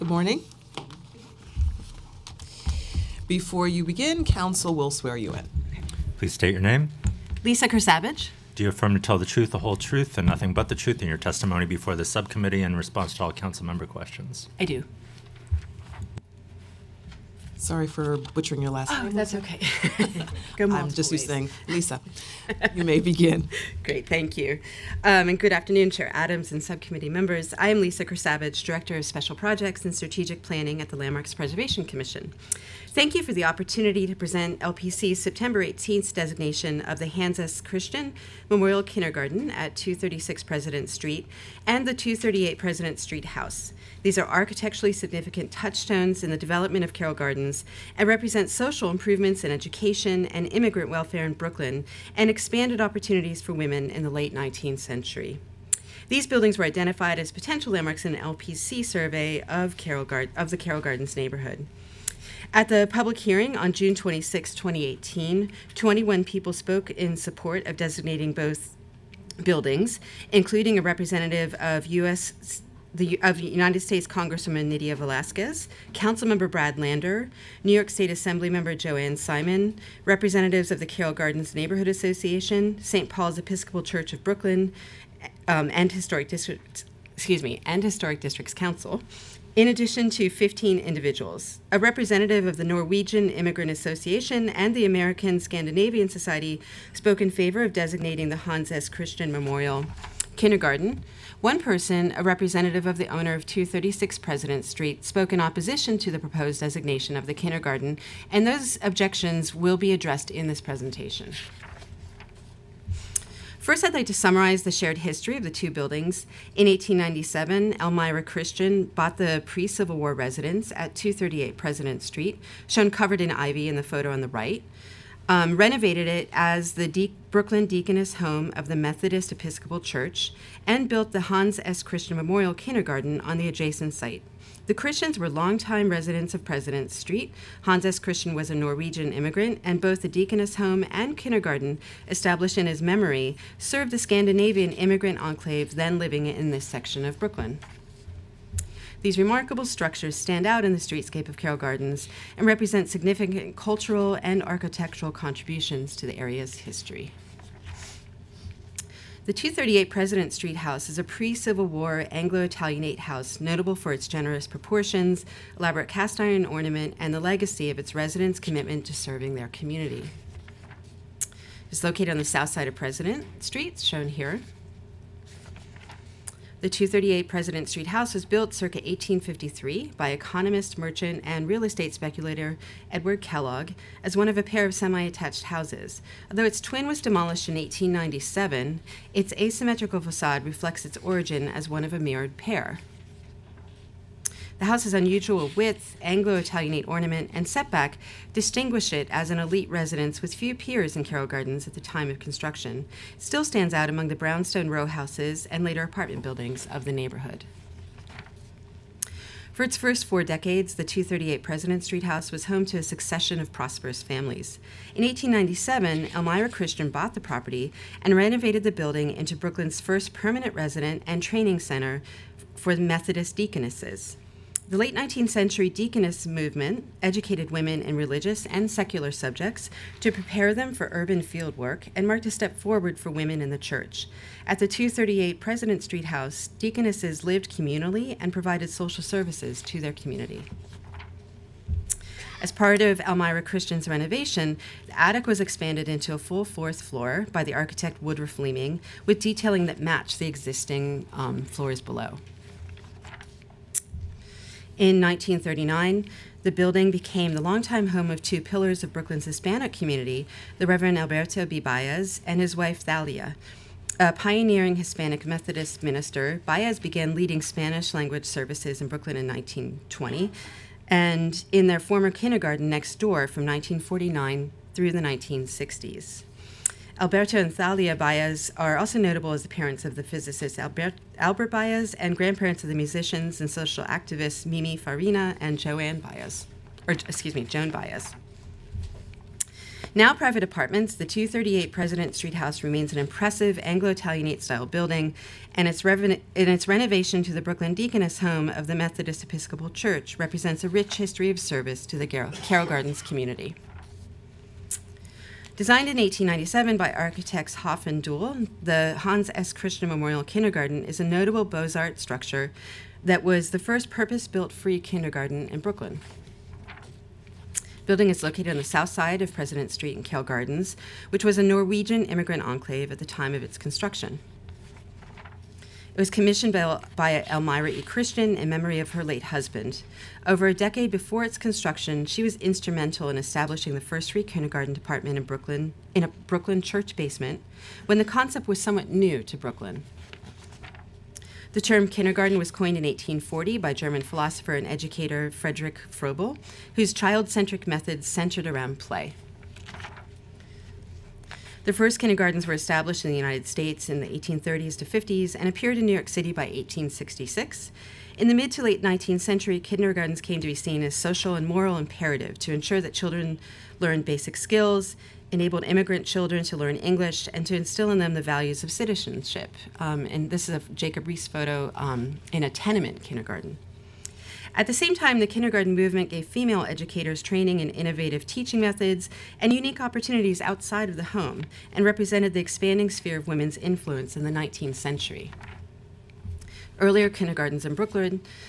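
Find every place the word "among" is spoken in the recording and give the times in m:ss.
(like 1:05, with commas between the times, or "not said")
3:23.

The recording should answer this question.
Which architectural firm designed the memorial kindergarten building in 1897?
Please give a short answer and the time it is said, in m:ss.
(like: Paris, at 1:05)
Hough and Deuell, at 5:07.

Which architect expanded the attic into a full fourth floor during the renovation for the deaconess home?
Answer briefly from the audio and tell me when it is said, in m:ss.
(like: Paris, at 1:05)
Woodruff Leeming, at 4:08.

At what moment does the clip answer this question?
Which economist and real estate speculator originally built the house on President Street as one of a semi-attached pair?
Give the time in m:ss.
3:02.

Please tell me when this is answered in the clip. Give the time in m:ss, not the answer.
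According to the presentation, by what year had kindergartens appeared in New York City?
5:56.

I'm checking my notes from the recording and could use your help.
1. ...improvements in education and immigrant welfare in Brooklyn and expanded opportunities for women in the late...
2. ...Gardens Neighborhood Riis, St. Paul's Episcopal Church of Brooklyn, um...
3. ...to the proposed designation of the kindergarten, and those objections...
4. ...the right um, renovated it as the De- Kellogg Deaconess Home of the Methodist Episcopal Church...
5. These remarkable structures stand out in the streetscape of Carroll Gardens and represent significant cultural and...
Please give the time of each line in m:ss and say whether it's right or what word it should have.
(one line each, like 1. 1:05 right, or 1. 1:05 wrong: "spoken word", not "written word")
1. 0:48 right
2. 1:21 wrong: "Association", not "Riis"
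3. 1:45 right
4. 2:04 wrong: "Brooklyn", not "Kellogg"
5. 2:29 right.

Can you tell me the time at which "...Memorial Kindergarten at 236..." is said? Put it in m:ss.
0:38.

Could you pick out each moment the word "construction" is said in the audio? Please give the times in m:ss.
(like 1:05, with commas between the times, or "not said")
3:22, 5:23, 5:31.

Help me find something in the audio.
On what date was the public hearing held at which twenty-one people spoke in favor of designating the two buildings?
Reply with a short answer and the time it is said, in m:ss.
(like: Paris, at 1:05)
June 26, 2018, at 1:03.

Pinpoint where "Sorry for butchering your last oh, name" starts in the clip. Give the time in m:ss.
0:17.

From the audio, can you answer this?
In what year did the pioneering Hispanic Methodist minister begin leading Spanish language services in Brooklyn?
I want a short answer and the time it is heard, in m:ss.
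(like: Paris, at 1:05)
1920, at 4:29.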